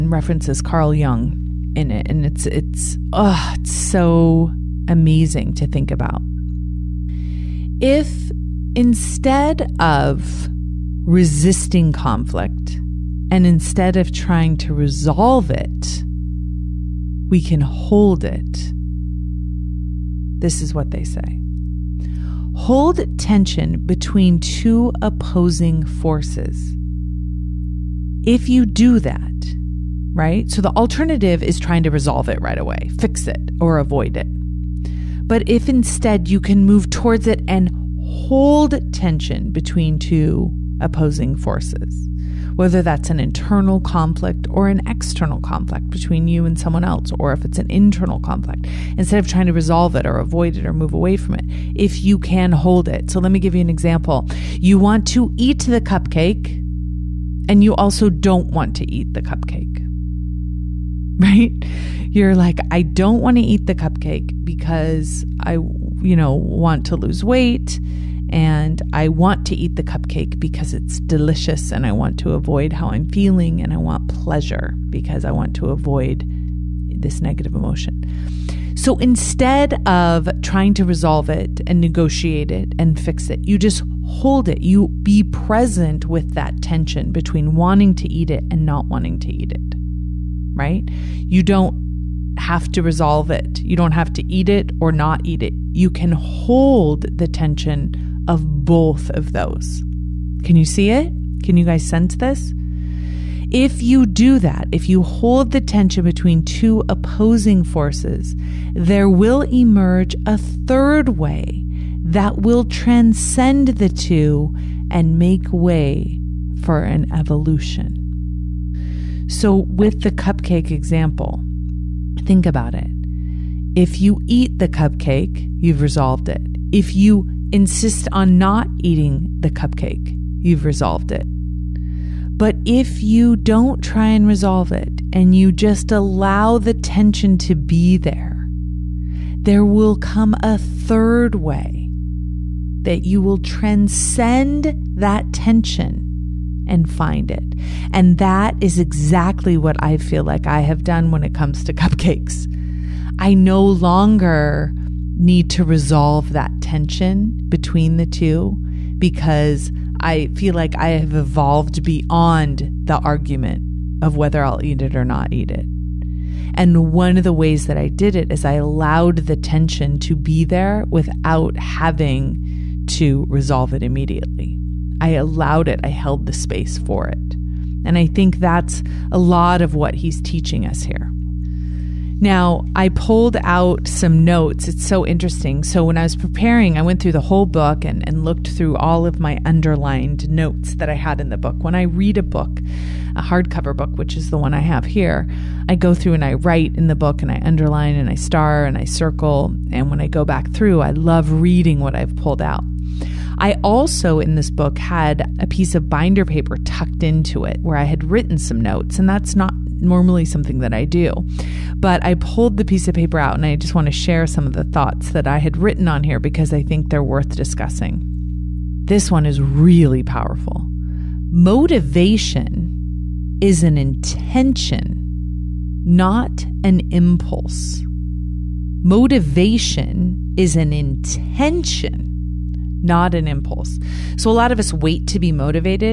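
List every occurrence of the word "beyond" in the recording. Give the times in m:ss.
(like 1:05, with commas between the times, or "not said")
2:41.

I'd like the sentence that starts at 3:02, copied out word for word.
Now, I pulled out some notes.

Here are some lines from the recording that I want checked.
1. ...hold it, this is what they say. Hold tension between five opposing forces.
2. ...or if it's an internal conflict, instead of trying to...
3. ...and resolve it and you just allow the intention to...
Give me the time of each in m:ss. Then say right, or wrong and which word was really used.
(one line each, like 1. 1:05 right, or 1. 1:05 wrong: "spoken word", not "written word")
1. 0:17 wrong: "two", not "five"
2. 0:47 right
3. 2:14 wrong: "tension", not "intention".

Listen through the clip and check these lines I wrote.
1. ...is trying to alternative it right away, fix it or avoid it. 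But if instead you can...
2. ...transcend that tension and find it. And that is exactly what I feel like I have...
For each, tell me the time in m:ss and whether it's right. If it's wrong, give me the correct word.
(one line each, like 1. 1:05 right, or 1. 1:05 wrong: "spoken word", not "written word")
1. 0:31 wrong: "resolve", not "alternative"
2. 2:23 right.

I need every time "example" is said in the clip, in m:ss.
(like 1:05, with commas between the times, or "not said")
0:53, 2:00.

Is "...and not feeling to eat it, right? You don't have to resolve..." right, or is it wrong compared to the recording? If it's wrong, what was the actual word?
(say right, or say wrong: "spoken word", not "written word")
wrong: "wanting", not "feeling".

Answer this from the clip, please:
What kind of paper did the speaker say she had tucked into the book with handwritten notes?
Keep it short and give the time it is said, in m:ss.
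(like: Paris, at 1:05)
Binder paper, at 3:25.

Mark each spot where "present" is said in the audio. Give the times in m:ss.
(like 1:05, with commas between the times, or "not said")
1:25.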